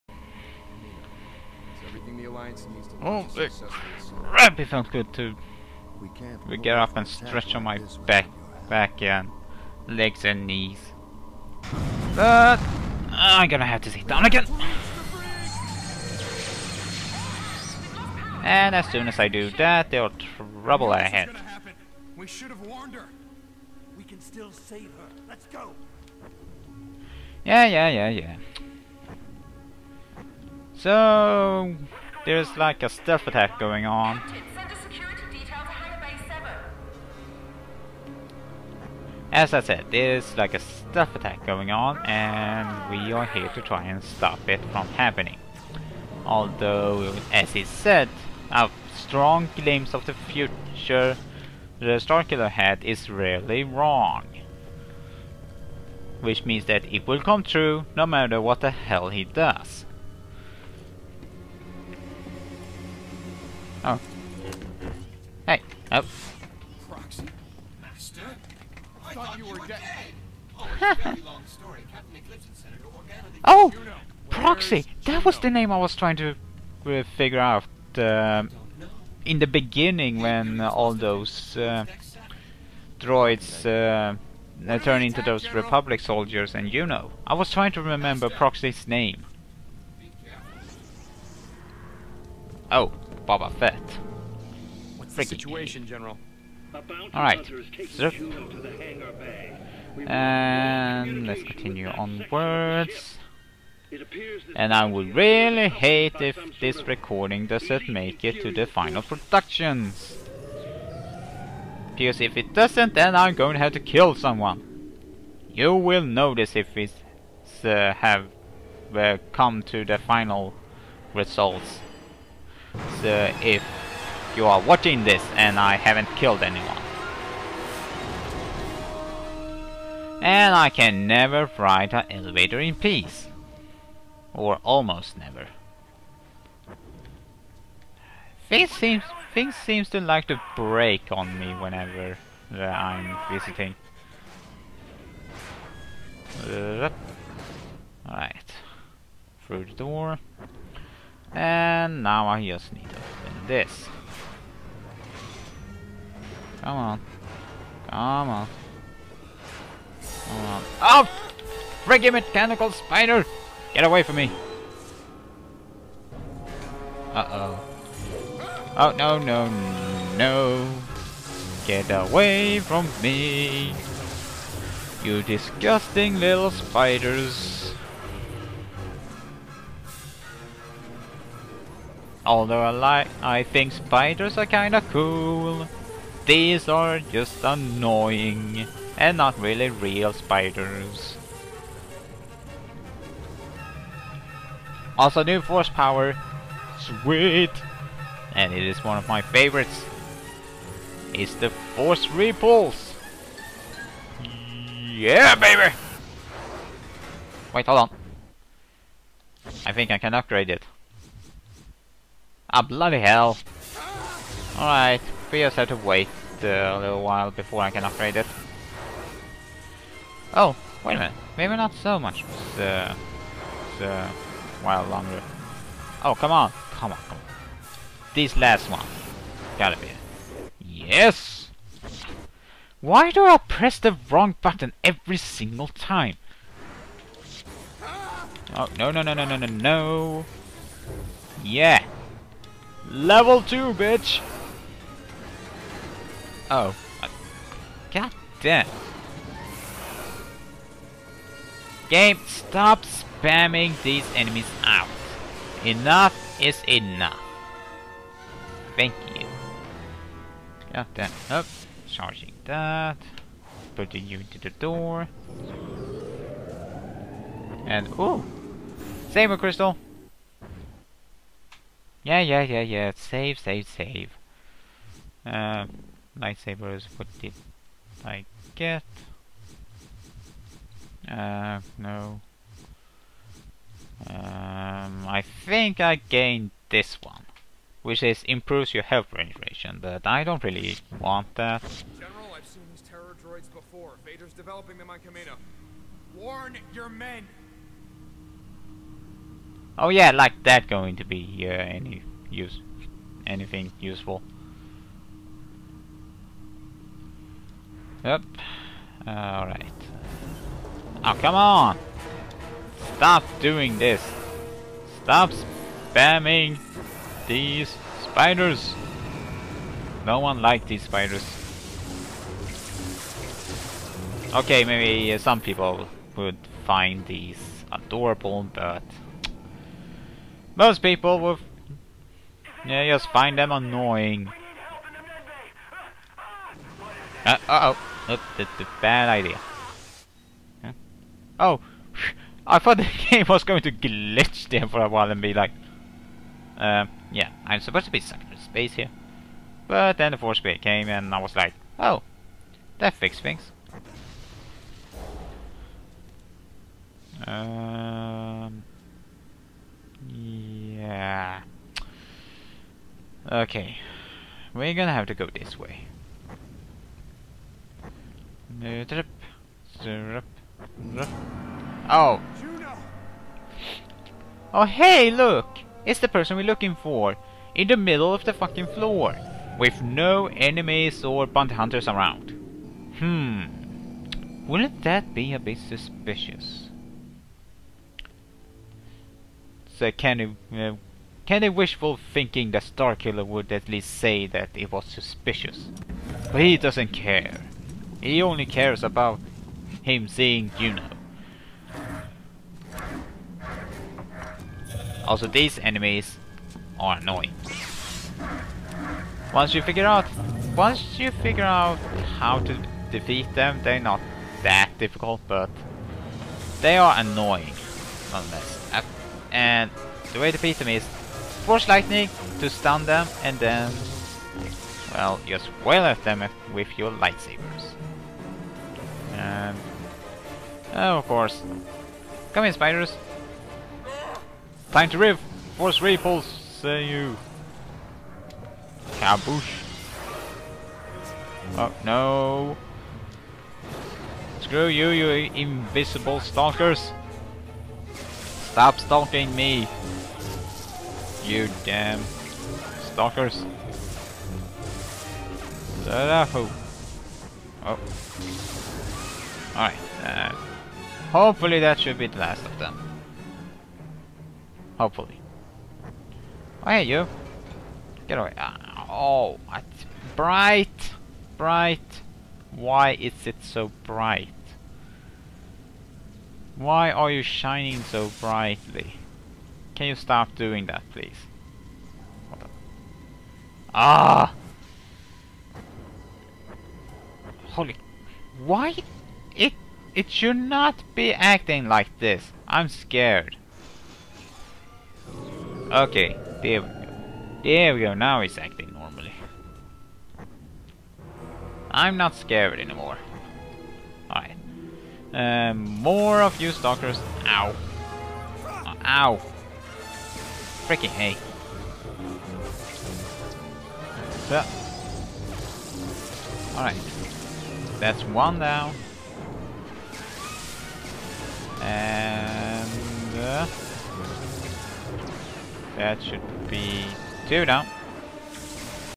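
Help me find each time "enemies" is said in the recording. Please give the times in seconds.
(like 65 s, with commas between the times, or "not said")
254 s, 380 s, 405 s.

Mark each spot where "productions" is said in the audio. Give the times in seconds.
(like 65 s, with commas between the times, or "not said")
109 s.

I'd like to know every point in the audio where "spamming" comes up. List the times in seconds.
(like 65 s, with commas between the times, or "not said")
252 s, 315 s.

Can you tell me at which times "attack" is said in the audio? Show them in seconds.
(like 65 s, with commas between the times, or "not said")
33 s, 41 s.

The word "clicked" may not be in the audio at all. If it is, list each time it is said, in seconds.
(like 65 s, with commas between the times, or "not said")
not said.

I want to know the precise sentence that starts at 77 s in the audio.
Uh, in the beginning when uh, all those droids uh, uh, turn into those Republic soldiers and you know.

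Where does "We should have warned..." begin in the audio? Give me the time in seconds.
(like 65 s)
22 s.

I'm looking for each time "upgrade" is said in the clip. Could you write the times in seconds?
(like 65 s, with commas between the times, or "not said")
210 s, 217 s.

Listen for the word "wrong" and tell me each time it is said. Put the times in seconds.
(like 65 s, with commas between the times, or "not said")
53 s, 234 s.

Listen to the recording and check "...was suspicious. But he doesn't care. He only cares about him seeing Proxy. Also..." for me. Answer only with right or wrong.
wrong.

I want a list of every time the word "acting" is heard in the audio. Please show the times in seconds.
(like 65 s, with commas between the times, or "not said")
491 s, 498 s.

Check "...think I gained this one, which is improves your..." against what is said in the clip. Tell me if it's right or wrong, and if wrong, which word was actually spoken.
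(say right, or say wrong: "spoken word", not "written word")
right.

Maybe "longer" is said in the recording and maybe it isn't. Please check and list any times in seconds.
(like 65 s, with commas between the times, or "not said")
224 s.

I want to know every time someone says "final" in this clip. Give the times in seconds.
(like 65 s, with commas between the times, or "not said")
108 s, 119 s.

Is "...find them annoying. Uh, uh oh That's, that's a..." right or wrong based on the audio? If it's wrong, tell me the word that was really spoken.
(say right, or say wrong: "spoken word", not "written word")
right.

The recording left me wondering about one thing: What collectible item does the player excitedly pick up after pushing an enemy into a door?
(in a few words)
Saber crystal.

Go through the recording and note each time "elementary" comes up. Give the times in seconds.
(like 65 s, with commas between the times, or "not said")
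not said.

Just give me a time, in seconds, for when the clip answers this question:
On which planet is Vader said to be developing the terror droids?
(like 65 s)
294 s.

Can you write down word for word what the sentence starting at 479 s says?
Can you stop doing that, please?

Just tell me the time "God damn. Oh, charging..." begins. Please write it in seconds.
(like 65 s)
260 s.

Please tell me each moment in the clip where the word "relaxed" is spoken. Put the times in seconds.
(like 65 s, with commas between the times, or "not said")
not said.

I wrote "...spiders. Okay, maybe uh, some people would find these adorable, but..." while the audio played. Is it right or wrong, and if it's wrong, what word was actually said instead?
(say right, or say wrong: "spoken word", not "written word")
right.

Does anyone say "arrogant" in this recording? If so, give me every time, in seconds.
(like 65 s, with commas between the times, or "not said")
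not said.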